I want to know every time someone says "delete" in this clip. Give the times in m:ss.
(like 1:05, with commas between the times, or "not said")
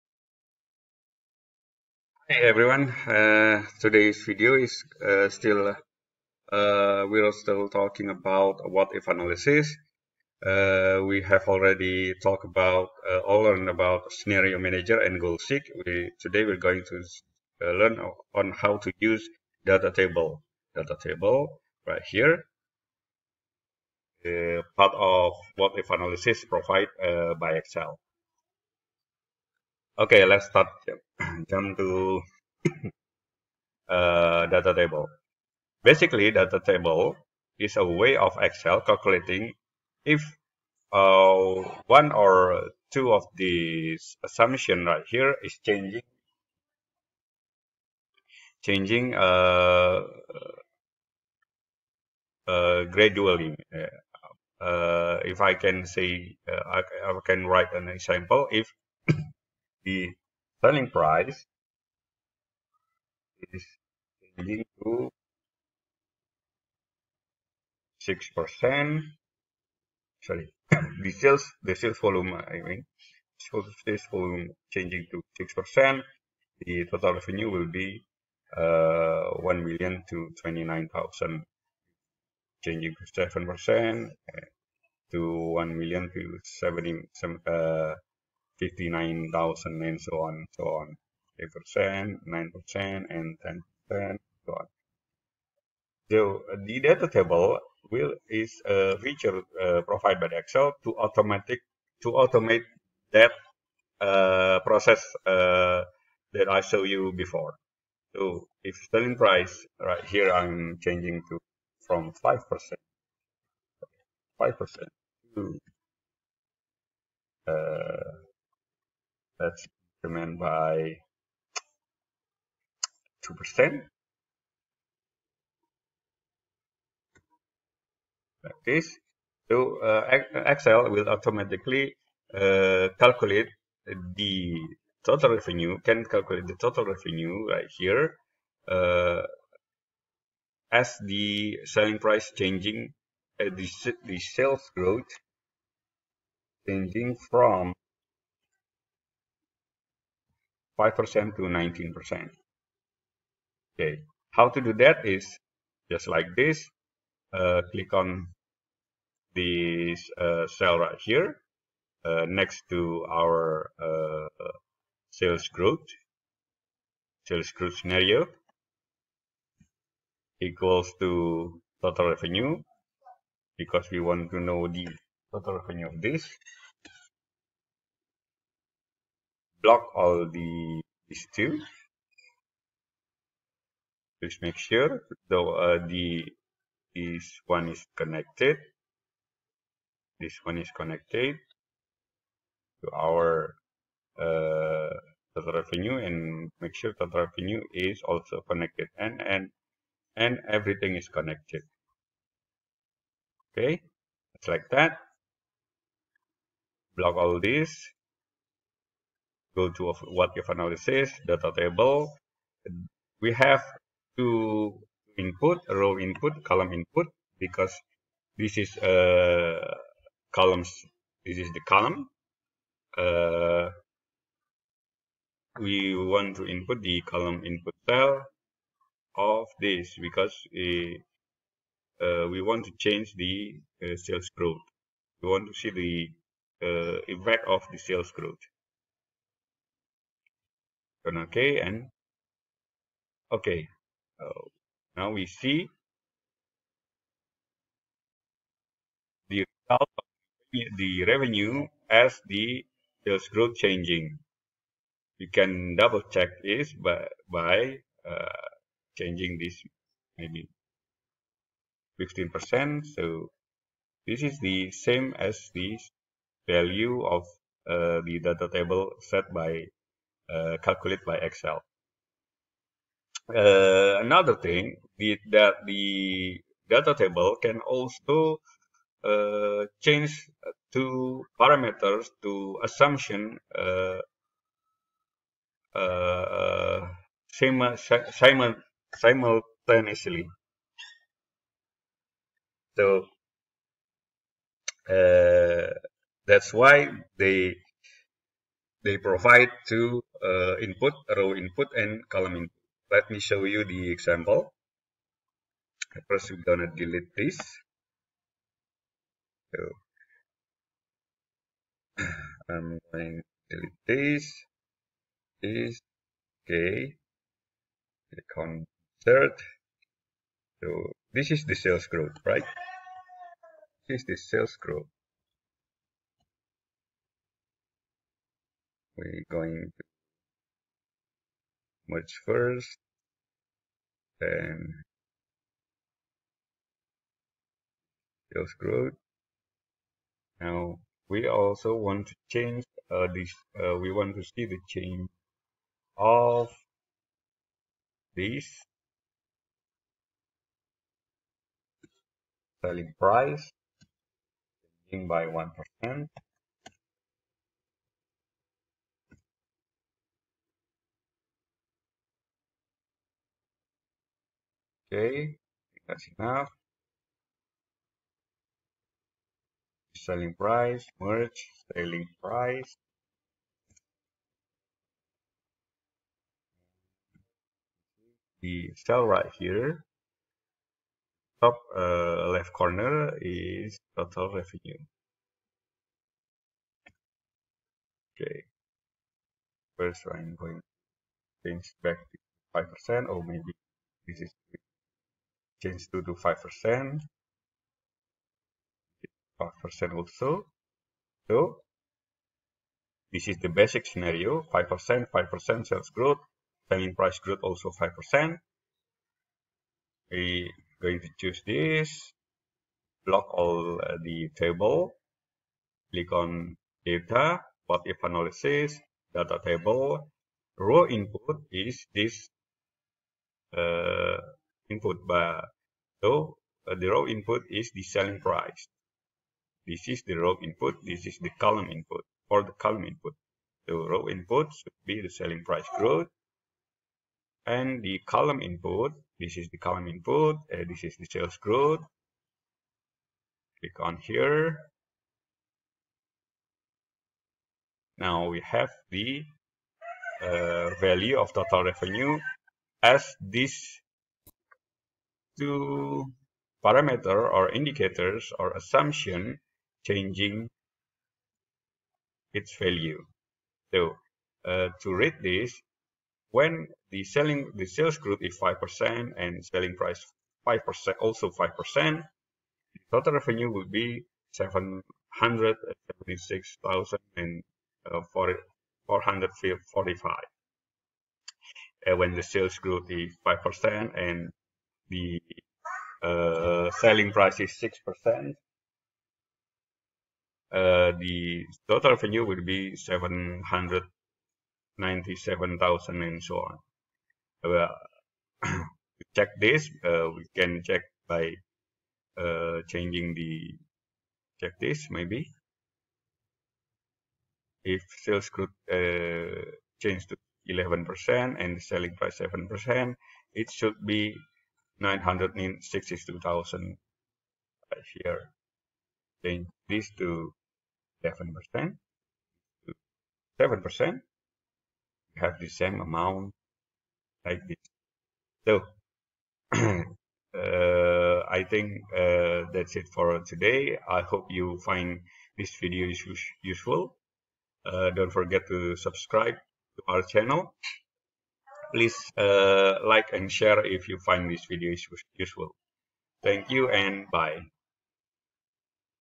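5:06, 5:13.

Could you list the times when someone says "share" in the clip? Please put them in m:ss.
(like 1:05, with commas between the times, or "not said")
9:03.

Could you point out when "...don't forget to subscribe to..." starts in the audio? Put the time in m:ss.
8:57.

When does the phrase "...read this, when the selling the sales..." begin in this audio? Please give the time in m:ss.
7:44.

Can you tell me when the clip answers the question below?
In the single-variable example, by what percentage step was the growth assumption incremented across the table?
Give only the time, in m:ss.
2:03.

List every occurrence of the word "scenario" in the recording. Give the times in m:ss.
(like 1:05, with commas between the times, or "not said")
0:14, 2:47, 6:43.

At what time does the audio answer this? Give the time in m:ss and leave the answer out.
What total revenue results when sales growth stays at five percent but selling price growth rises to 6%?
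8:12.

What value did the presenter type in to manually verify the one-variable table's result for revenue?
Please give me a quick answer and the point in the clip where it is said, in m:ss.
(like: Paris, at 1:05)
15%, at 4:21.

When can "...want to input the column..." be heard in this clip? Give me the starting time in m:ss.
3:45.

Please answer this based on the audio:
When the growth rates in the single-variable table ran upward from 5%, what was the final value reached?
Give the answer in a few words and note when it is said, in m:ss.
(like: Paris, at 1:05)
19%, at 2:31.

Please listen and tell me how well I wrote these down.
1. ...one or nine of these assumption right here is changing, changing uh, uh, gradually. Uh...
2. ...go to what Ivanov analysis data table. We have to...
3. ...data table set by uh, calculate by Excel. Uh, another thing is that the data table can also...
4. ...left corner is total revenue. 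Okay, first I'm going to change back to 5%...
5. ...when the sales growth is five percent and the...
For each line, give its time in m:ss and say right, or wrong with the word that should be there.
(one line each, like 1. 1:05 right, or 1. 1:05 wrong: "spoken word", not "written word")
1. 0:41 wrong: "two", not "nine"
2. 3:29 right
3. 4:28 right
4. 6:22 right
5. 8:01 right.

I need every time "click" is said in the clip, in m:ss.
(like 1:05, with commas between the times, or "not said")
2:37, 5:18, 6:55, 7:23.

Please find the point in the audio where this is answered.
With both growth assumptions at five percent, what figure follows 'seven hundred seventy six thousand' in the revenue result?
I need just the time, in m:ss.
7:58.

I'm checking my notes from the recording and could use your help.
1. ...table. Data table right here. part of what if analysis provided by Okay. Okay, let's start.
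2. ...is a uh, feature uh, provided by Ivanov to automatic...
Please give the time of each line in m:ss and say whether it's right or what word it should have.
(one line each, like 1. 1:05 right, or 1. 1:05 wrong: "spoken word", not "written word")
1. 0:19 wrong: "Excel", not "Okay"
2. 1:38 wrong: "Excel", not "Ivanov".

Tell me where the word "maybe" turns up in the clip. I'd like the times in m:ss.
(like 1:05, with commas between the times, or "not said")
4:20, 6:33, 8:24.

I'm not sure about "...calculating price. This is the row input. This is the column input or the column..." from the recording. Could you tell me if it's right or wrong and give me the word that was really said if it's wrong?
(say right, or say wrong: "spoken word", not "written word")
wrong: "selling", not "calculating".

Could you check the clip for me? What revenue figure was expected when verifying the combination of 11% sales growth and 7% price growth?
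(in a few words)
962,000.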